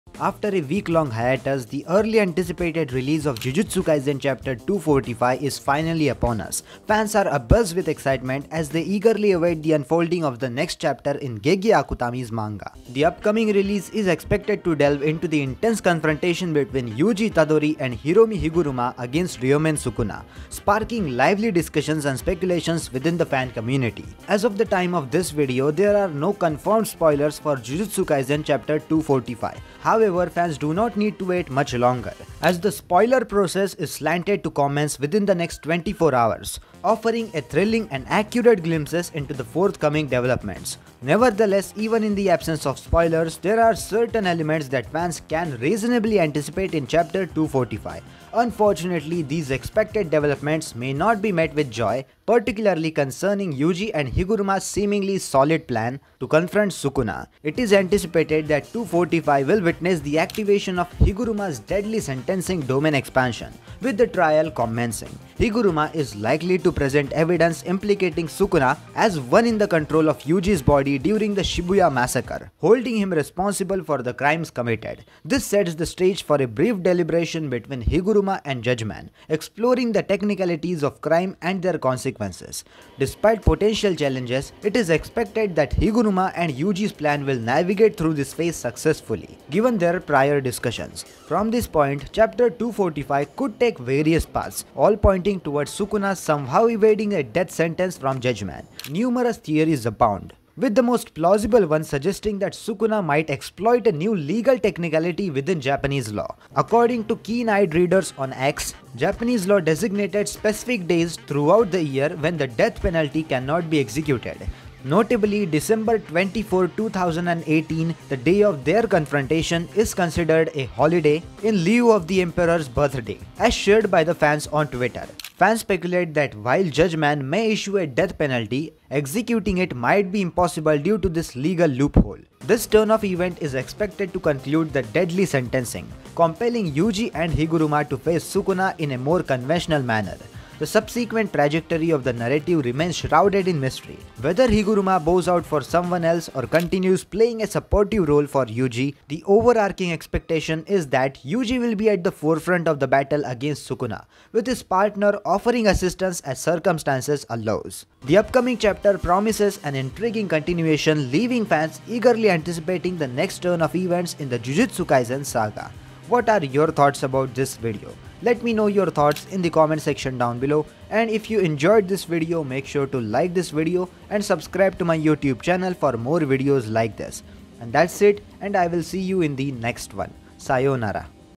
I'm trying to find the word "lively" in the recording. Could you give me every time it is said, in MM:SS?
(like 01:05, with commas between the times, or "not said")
00:21.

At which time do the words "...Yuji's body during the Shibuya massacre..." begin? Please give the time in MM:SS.
01:10.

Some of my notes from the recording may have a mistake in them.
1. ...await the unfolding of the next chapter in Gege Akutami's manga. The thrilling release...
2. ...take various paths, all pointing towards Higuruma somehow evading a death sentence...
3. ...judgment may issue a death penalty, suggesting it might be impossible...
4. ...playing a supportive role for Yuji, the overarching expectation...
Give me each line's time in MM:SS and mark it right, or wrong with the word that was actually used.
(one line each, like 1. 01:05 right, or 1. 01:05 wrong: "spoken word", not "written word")
1. 00:09 wrong: "upcoming", not "thrilling"
2. 01:33 wrong: "Sukuna", not "Higuruma"
3. 02:06 wrong: "executing", not "suggesting"
4. 02:27 right.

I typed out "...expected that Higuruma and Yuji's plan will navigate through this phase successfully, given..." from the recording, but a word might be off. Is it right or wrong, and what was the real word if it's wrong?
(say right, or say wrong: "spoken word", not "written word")
right.